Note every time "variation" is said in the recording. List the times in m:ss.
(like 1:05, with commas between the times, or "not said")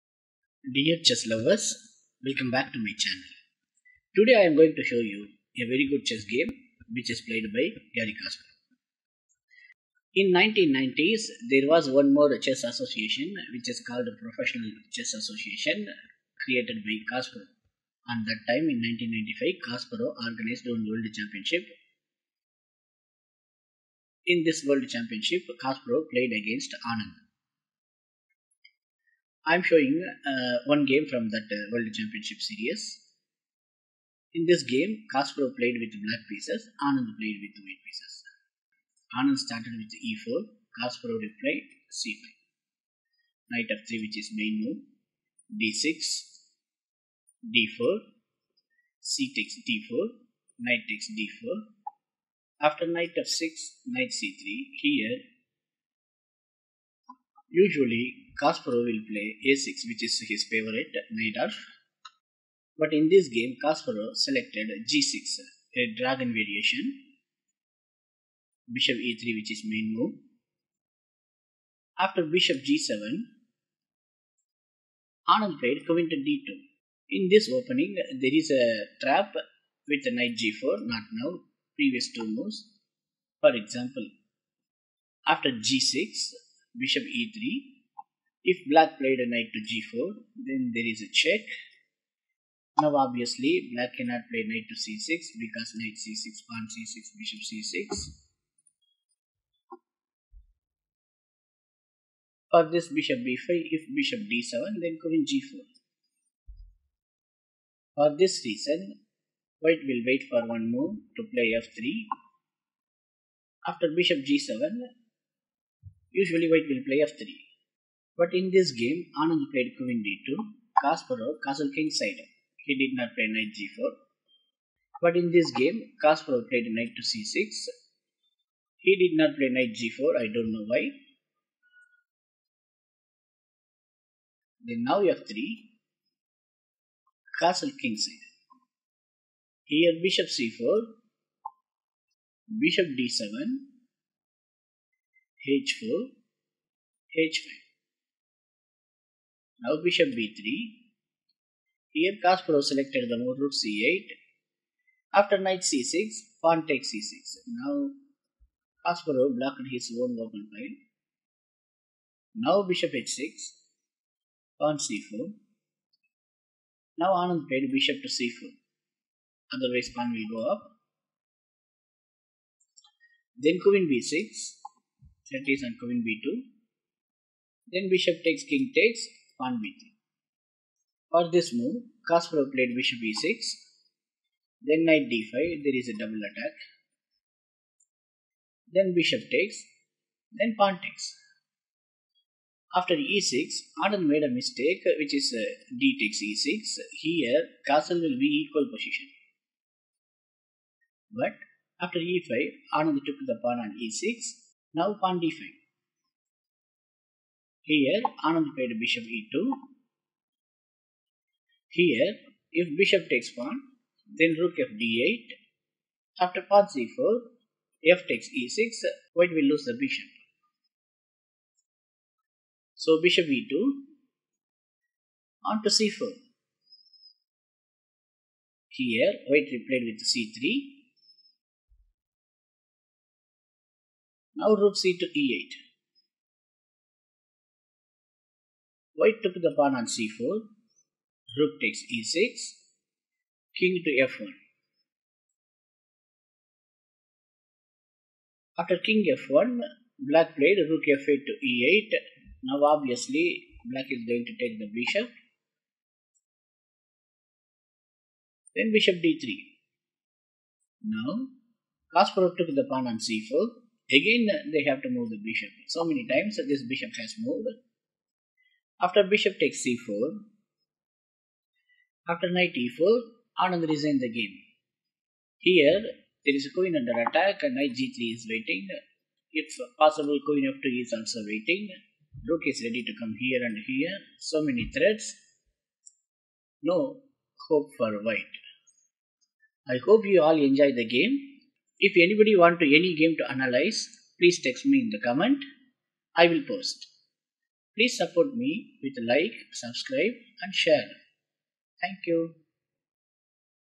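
1:06.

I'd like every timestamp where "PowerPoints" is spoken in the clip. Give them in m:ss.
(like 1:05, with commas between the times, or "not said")
not said.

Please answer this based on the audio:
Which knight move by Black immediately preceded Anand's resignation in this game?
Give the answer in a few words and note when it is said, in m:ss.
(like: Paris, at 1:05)
Knight e4, at 4:32.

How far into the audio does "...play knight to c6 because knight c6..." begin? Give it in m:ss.
1:34.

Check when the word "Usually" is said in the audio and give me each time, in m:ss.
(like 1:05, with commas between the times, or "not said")
0:57, 1:56.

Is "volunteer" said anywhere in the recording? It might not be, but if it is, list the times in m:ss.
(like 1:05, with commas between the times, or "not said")
not said.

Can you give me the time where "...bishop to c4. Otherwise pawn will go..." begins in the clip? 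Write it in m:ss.
2:47.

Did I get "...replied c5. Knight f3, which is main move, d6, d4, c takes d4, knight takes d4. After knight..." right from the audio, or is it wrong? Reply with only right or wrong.
right.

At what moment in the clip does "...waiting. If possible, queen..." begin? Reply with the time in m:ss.
4:38.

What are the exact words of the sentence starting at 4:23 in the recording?
Again, they have to move the bishop.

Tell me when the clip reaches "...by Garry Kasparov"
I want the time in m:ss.
0:07.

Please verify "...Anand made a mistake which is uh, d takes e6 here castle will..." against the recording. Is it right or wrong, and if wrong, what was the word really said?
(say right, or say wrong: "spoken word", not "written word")
right.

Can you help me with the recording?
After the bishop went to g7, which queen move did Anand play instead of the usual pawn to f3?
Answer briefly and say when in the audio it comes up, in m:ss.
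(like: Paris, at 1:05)
Queen d2, at 1:15.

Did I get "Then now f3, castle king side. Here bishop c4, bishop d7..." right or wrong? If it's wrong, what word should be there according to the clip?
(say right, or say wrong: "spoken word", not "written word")
right.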